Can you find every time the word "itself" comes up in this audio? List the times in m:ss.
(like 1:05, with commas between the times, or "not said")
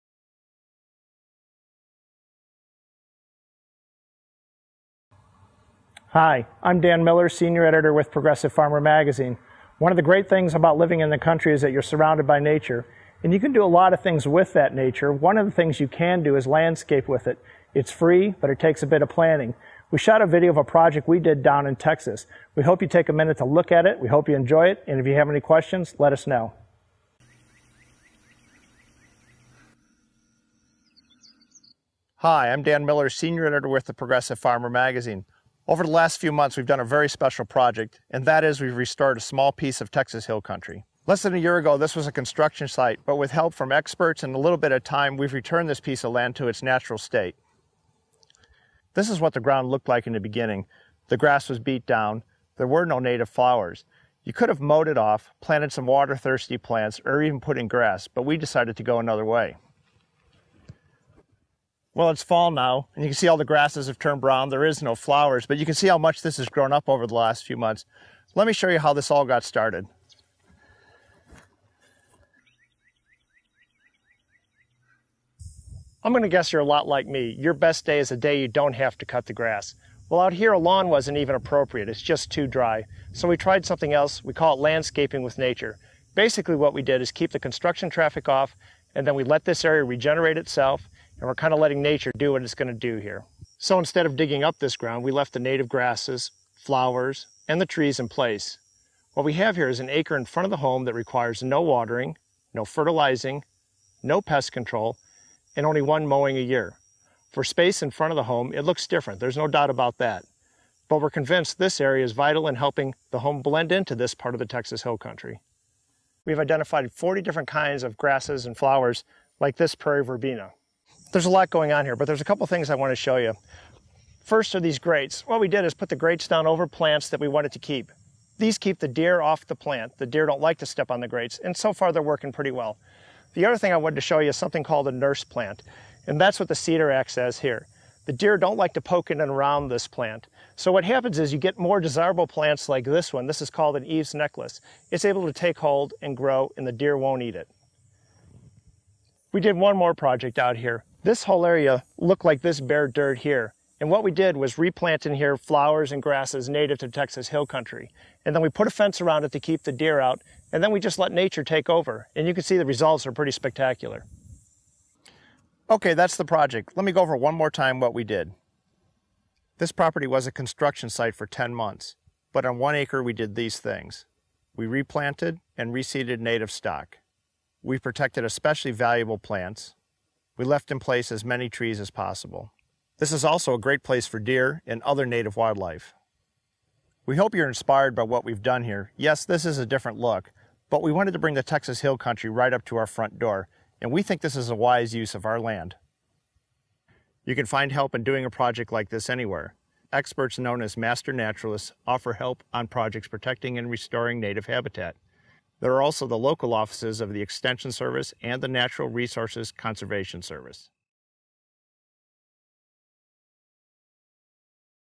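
1:30.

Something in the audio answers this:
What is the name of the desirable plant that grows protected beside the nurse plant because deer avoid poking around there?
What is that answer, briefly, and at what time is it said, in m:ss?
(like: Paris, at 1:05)
Eve's necklace, at 2:23.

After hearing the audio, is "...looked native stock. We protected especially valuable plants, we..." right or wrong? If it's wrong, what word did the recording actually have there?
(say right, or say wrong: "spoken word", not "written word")
wrong: "reseeded", not "looked".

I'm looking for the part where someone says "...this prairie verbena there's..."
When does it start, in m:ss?
1:59.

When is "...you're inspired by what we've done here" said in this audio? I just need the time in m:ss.
3:07.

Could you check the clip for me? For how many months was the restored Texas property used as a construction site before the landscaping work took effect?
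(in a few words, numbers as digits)
10.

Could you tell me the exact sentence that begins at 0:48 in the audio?
This is what the ground looked like in the beginning.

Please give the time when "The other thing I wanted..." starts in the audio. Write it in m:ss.
2:13.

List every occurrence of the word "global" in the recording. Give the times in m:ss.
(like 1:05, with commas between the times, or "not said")
not said.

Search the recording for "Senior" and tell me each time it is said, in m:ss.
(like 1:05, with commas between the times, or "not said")
0:07, 0:33.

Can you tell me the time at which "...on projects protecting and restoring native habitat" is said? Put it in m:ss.
3:22.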